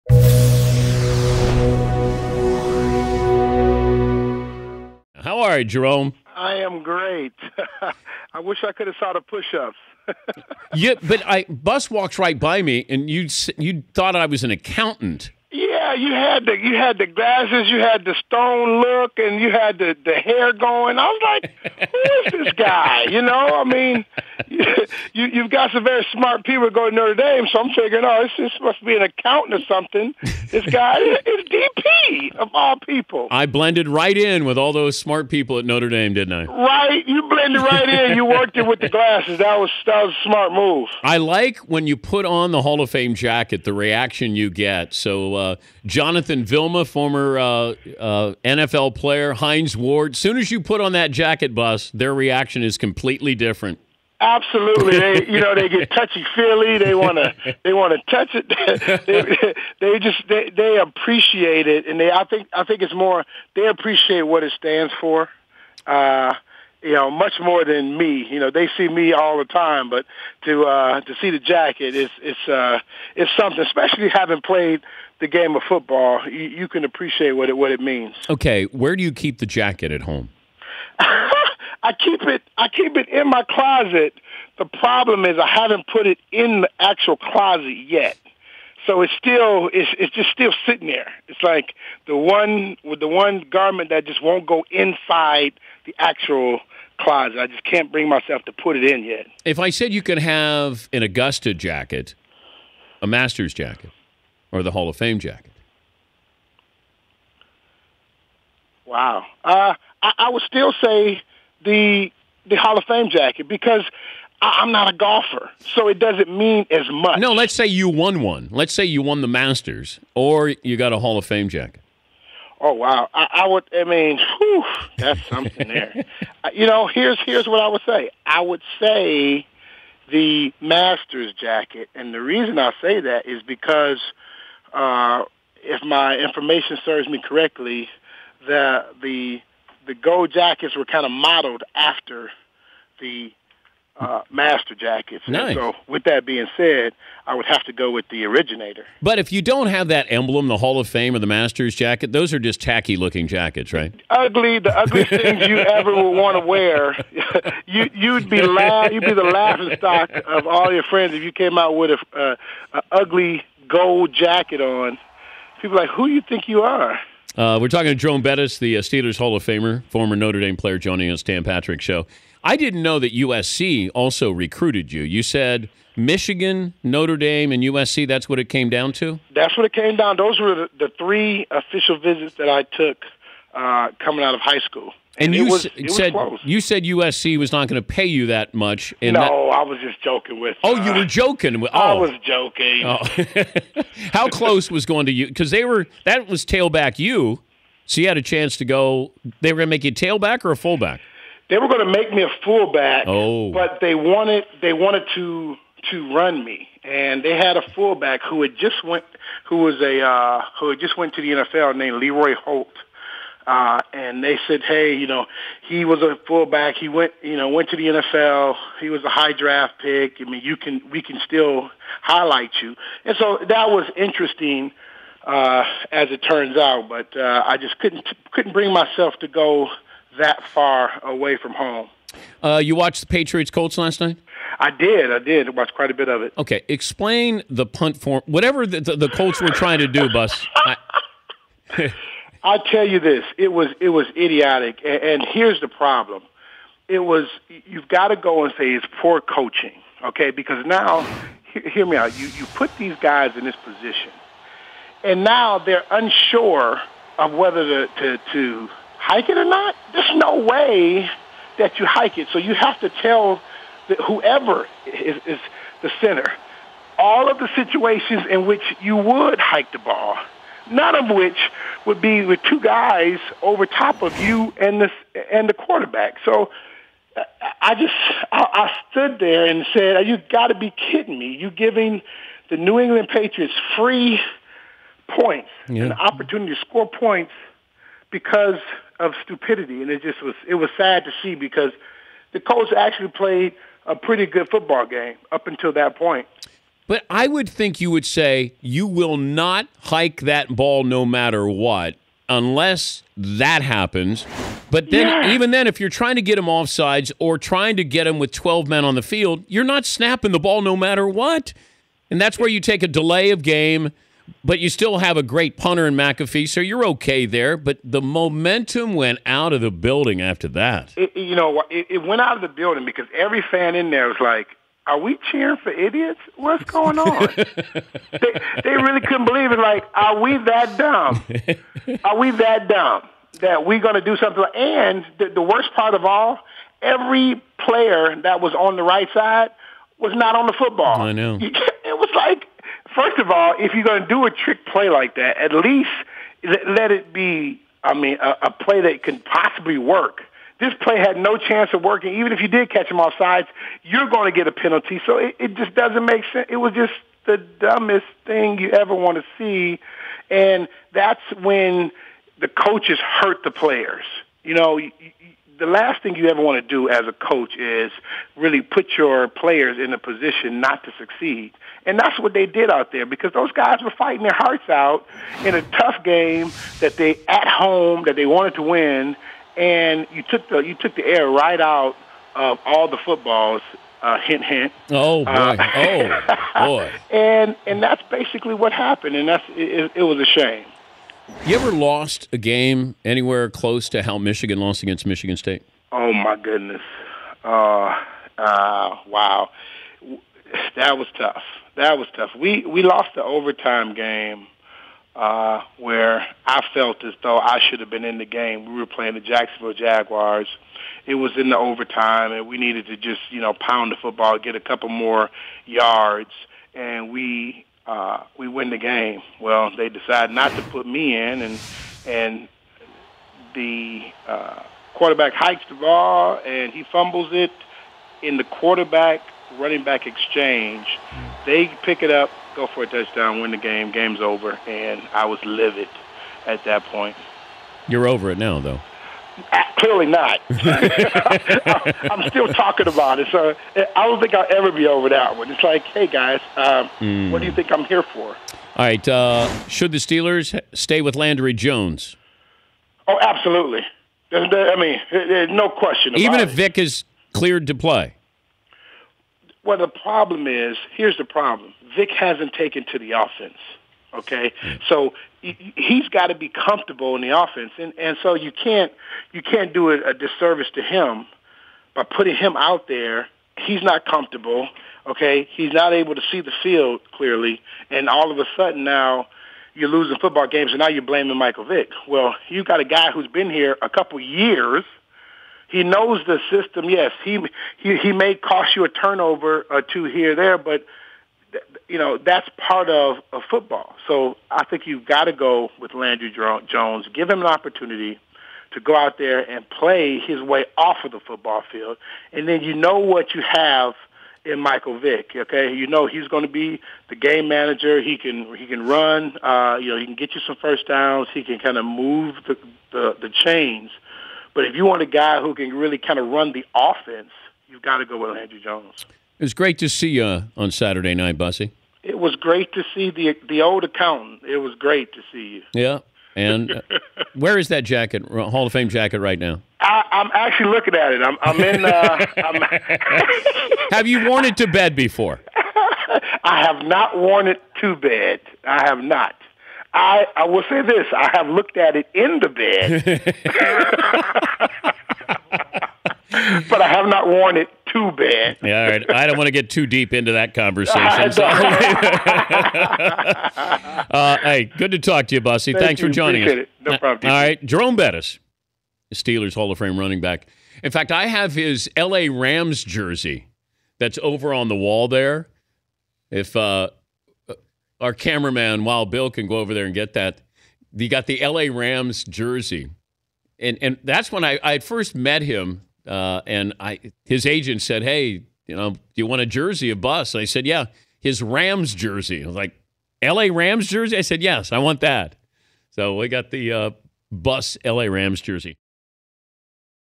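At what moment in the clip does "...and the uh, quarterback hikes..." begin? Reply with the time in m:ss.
7:02.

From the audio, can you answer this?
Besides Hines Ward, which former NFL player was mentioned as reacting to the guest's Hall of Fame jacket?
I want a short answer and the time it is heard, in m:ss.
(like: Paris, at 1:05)
Jonathan Vilma, at 0:45.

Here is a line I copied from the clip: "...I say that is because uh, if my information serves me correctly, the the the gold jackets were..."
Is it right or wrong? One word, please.
right.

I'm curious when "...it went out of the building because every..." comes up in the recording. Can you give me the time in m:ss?
5:21.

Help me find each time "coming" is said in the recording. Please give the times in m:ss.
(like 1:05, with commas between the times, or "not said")
3:04.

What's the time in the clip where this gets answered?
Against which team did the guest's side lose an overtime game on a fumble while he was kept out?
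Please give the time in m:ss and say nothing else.
6:49.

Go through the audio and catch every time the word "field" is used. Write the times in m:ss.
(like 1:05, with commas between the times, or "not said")
5:09, 7:56, 8:21.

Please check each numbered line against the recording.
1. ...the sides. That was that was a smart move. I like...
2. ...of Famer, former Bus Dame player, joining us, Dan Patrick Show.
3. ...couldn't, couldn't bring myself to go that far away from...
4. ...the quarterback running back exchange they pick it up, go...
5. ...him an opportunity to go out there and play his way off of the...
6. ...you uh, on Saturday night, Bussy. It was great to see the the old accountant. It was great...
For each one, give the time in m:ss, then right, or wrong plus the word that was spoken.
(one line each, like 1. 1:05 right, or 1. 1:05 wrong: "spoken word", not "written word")
1. 0:38 wrong: "glasses", not "sides"
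2. 2:49 wrong: "Notre", not "Bus"
3. 3:47 right
4. 7:08 right
5. 8:17 right
6. 8:40 right.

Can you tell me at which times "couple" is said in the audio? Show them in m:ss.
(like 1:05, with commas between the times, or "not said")
6:54, 8:03.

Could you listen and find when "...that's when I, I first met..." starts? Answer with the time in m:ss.
9:34.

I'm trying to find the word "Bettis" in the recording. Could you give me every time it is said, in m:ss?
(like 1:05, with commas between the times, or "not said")
2:48, 9:17.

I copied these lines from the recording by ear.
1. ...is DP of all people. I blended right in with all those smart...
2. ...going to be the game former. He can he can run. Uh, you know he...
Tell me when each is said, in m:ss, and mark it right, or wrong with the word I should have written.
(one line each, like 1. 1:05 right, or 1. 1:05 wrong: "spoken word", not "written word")
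1. 0:30 right
2. 8:26 wrong: "manager", not "former".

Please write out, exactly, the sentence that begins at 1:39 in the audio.
If I said you could have an Augusta jacket, a Masters jacket, or the Hall of Fame jacket.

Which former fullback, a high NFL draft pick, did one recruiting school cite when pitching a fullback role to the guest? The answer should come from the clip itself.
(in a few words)
Leroy Holt.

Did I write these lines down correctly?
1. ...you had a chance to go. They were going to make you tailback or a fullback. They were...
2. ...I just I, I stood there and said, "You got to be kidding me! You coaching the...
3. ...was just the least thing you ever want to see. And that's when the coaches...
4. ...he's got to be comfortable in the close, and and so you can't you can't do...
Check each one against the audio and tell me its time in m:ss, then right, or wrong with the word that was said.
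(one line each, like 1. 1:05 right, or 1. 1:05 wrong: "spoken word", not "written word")
1. 3:17 right
2. 4:37 wrong: "giving", not "coaching"
3. 5:56 wrong: "dumbest", not "least"
4. 7:45 wrong: "offense", not "close".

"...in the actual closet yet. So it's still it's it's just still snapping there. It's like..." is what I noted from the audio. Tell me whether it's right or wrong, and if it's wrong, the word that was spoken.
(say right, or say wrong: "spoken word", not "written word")
wrong: "sitting", not "snapping".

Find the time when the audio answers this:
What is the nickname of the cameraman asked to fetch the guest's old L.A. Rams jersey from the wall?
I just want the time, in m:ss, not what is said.
9:28.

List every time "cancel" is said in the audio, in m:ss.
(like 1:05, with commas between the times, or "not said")
not said.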